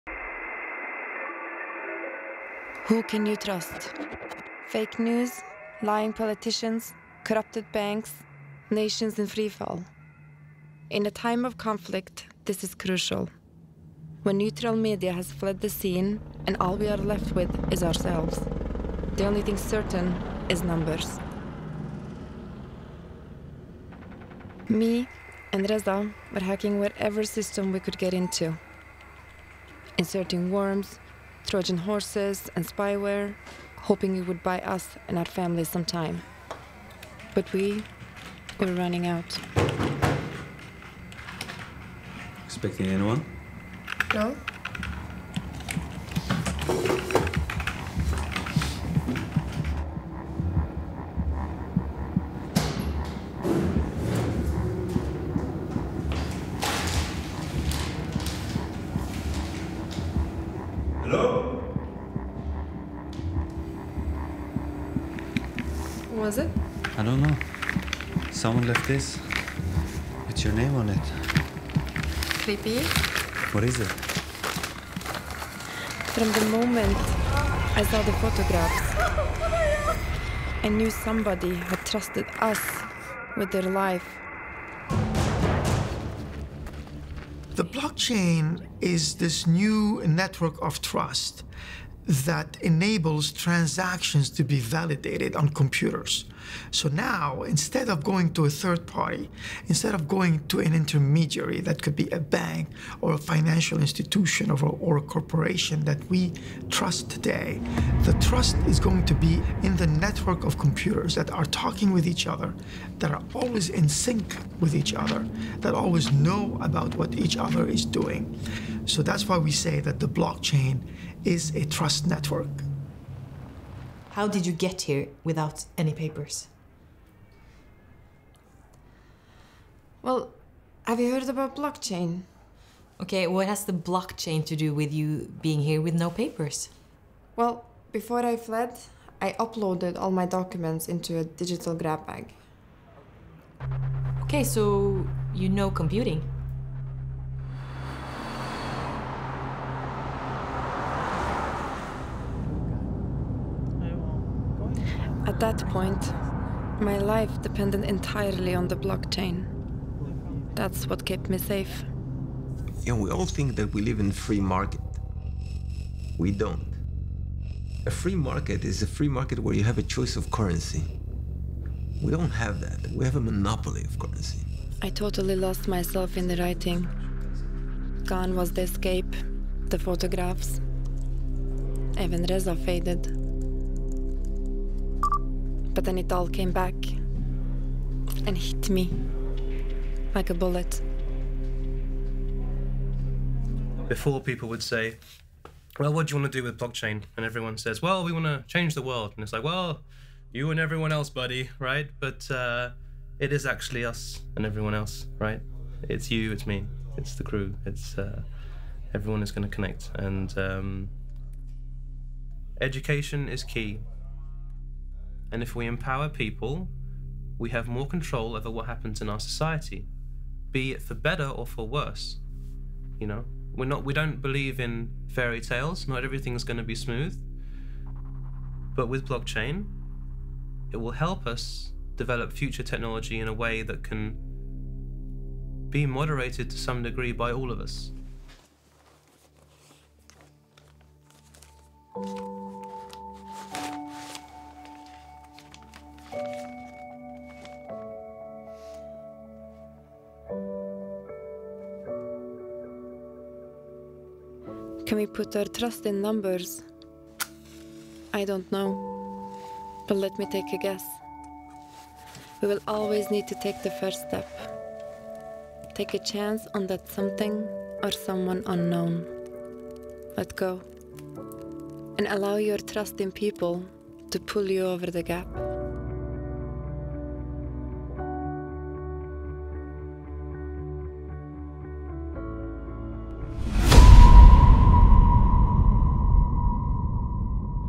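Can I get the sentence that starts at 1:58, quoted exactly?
So that's why we say that the blockchain is a trust network.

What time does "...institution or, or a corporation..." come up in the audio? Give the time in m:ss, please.
1:43.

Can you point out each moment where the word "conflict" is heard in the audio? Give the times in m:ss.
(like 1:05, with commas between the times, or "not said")
0:11.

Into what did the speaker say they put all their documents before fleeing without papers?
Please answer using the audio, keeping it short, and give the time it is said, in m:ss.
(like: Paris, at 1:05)
a digital grab bag, at 2:21.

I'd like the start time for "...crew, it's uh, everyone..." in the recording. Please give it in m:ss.
3:27.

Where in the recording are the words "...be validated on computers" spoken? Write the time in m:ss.
1:34.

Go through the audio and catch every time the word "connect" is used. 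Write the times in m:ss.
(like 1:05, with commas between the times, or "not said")
3:29.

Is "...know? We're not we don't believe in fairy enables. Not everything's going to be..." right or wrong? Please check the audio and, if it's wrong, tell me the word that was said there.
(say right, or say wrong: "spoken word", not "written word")
wrong: "tales", not "enables".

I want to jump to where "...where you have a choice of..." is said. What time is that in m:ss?
2:49.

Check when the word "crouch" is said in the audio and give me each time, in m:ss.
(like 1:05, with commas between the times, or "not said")
not said.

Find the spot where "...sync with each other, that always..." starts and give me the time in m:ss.
1:53.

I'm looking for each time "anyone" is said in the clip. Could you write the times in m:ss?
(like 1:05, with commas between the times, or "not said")
0:42.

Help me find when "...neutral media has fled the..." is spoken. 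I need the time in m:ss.
0:14.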